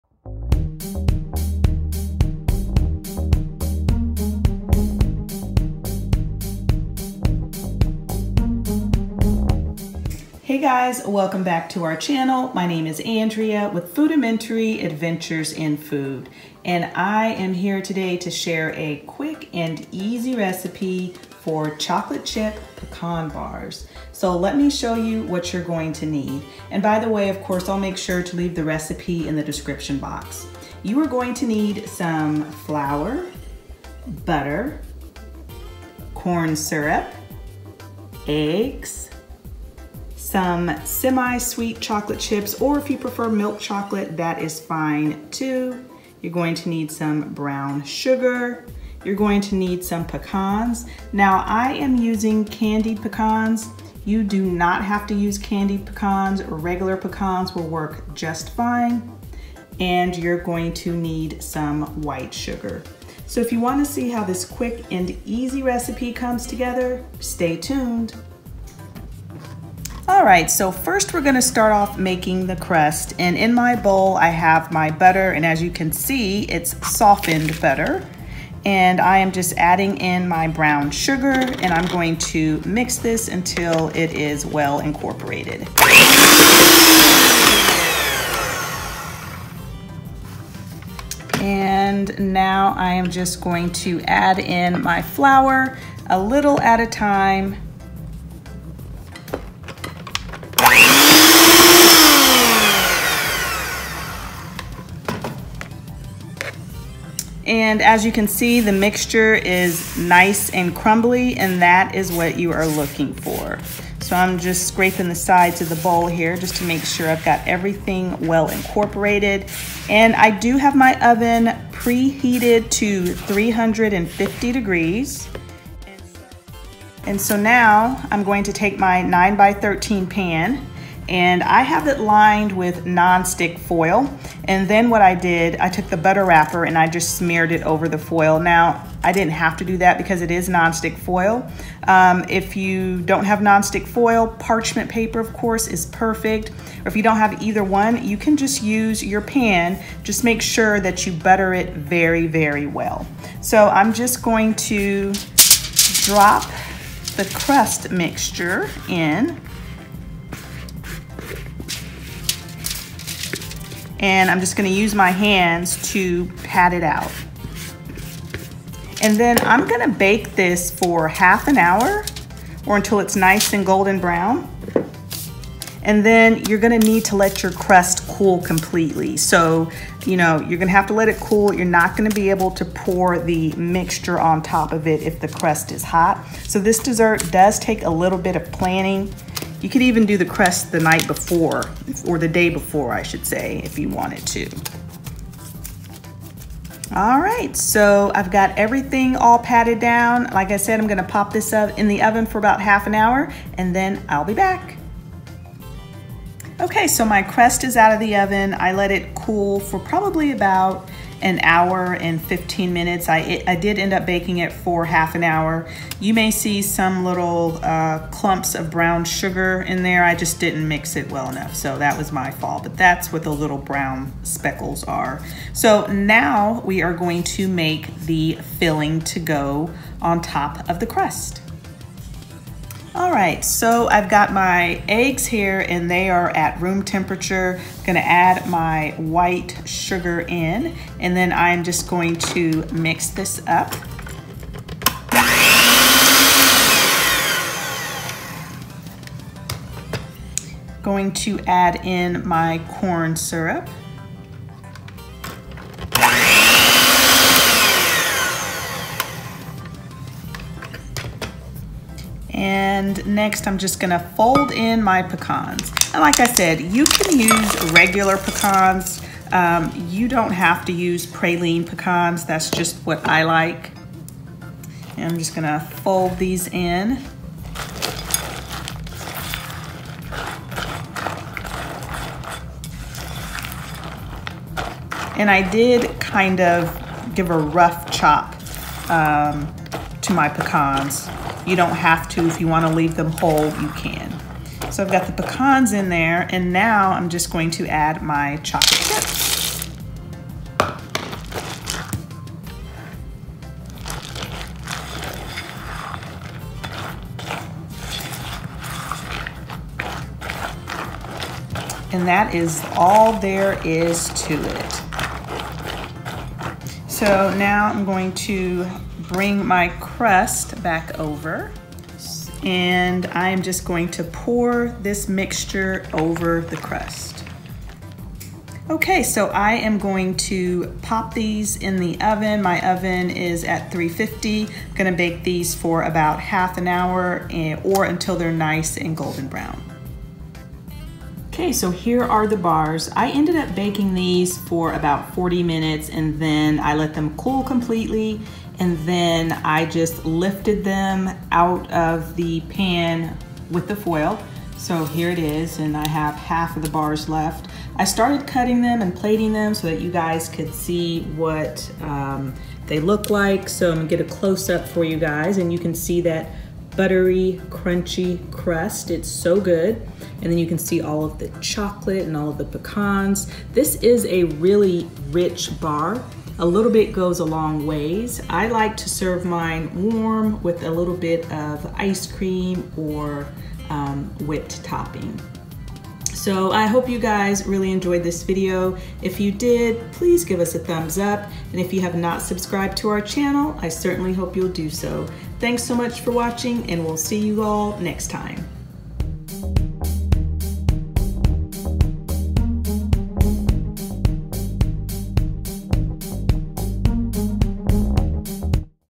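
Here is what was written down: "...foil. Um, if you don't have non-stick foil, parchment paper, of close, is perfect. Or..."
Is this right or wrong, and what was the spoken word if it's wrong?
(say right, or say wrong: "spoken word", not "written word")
wrong: "course", not "close".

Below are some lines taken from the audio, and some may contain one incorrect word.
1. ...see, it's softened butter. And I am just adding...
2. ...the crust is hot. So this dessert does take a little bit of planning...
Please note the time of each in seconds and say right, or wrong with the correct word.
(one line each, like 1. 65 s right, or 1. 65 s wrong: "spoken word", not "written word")
1. 75 s right
2. 185 s right.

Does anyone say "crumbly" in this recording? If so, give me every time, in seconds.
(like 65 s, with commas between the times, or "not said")
110 s.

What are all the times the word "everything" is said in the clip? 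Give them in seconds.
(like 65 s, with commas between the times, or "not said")
117 s, 198 s.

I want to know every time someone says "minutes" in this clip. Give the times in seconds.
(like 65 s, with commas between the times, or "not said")
212 s, 345 s.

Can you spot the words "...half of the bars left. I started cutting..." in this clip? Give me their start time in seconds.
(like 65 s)
356 s.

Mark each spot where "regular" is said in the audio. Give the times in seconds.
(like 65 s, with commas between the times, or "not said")
56 s, 267 s.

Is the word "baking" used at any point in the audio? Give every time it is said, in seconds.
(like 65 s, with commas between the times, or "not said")
214 s, 343 s.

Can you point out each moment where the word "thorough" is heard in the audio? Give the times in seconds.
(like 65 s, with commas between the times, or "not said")
not said.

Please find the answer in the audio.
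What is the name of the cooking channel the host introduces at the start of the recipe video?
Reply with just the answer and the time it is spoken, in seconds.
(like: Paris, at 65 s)
Foodamentary Adventures in Food, at 13 s.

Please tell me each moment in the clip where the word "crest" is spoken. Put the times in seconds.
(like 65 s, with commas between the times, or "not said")
190 s, 207 s.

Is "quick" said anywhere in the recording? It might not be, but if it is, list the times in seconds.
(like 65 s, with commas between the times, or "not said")
19 s, 64 s.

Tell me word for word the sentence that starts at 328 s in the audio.
Okay, so I am going to pop these in the oven.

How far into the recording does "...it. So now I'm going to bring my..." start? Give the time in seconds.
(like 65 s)
314 s.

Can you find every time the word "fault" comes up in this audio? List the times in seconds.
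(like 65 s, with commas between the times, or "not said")
222 s.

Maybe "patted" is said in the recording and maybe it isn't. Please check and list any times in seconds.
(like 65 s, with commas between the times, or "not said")
199 s.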